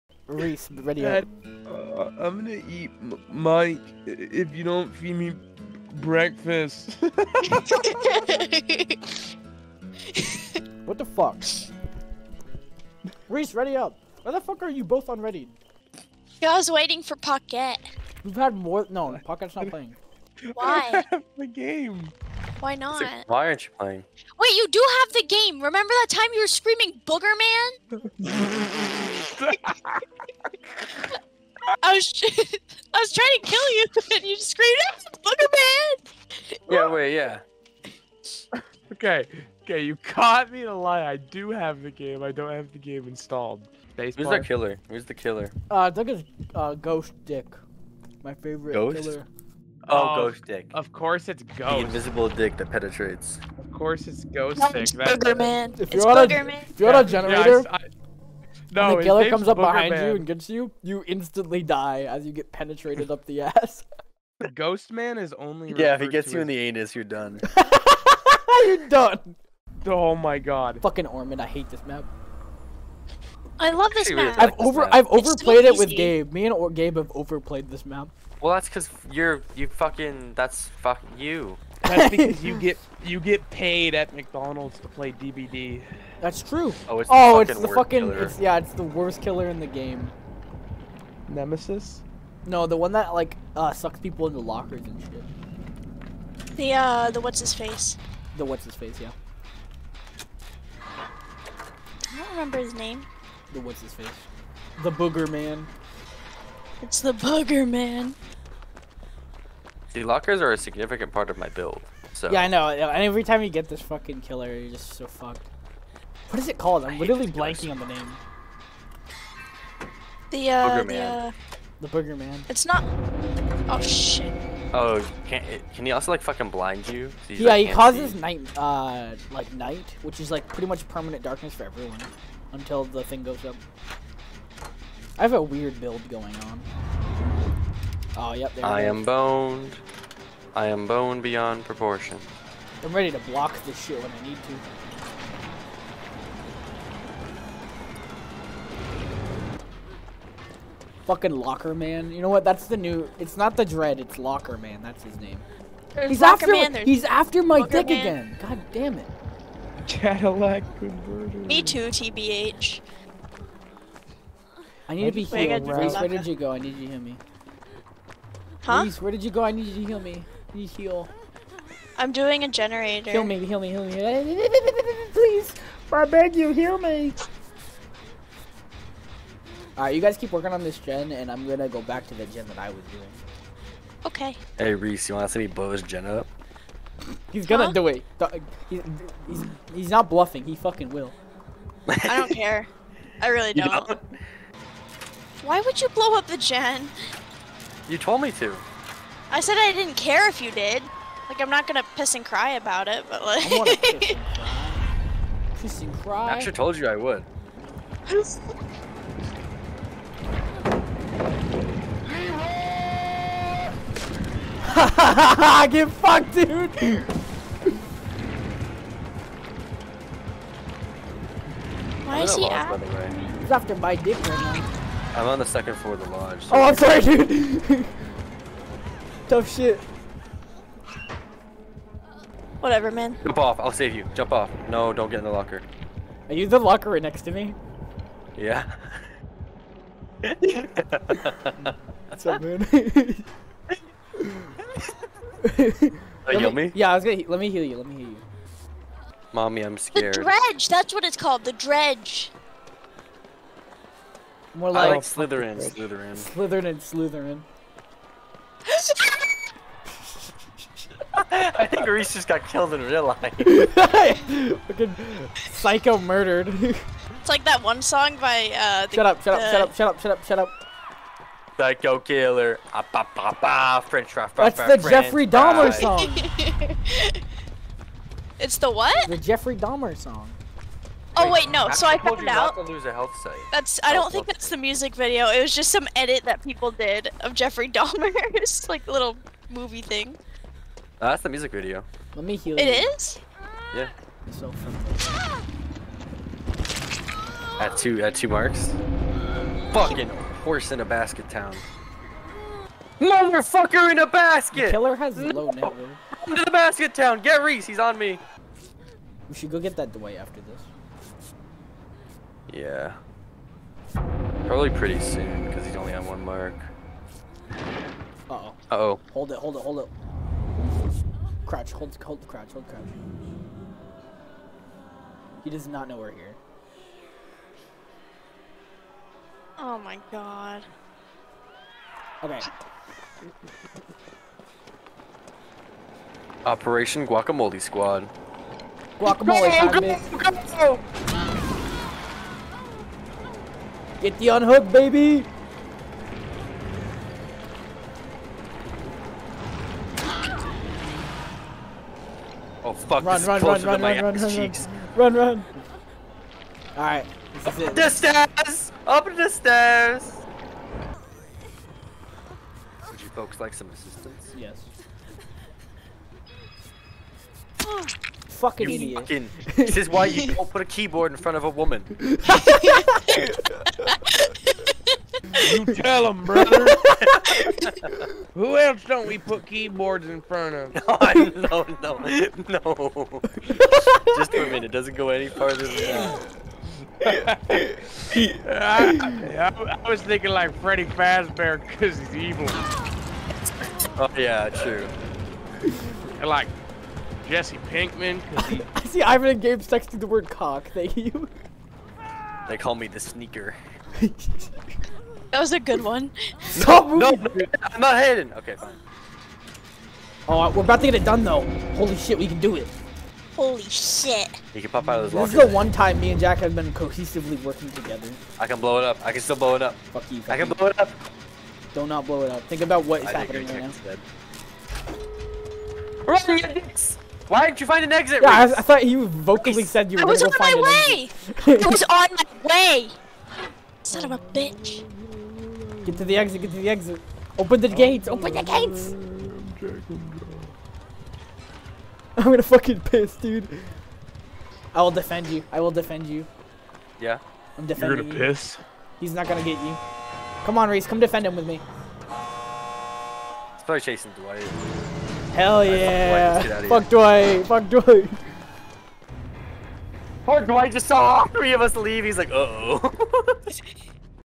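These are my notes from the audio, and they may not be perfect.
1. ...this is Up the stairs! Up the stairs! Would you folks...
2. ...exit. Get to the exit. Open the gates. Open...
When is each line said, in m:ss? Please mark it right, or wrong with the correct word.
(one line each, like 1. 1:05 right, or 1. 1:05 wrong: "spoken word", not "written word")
1. 5:57 right
2. 7:16 right.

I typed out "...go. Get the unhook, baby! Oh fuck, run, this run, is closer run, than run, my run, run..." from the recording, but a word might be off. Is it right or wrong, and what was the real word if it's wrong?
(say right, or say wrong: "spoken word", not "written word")
right.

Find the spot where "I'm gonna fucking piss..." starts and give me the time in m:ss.
7:22.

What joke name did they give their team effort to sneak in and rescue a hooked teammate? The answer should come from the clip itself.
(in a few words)
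Operation Guacamole Squad.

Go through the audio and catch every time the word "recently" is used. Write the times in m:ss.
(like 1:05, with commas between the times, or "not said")
not said.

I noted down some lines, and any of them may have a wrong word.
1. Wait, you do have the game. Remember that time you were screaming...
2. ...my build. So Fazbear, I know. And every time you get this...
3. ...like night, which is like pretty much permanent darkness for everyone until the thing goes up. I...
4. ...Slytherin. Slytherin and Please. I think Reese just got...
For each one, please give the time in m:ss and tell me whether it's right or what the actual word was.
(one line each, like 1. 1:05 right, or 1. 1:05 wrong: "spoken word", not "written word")
1. 0:24 right
2. 1:51 wrong: "Yeah", not "Fazbear"
3. 2:09 right
4. 4:15 wrong: "Slytherin", not "Please".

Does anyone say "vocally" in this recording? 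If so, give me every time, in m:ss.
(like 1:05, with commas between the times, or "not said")
7:09.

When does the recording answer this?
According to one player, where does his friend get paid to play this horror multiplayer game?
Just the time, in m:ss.
1:24.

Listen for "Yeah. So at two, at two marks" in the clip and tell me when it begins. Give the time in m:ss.
4:53.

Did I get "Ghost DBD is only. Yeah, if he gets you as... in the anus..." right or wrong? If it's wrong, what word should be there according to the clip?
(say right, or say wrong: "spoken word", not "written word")
wrong: "Man", not "DBD".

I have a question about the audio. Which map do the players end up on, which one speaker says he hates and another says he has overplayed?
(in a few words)
Ormond.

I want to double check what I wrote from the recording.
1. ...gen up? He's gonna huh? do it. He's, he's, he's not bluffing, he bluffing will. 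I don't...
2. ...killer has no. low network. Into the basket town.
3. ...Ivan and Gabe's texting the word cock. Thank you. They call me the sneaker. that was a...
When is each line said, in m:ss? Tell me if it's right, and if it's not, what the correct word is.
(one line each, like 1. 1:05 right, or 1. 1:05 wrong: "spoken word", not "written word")
1. 3:05 wrong: "fucking", not "bluffing"
2. 5:04 right
3. 6:39 right.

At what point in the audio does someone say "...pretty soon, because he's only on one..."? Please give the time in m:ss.
5:14.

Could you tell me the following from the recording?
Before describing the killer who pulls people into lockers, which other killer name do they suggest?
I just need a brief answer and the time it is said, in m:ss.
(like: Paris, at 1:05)
Nemesis, at 1:31.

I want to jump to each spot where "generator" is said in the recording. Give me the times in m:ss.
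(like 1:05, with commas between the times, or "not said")
0:57, 2:52.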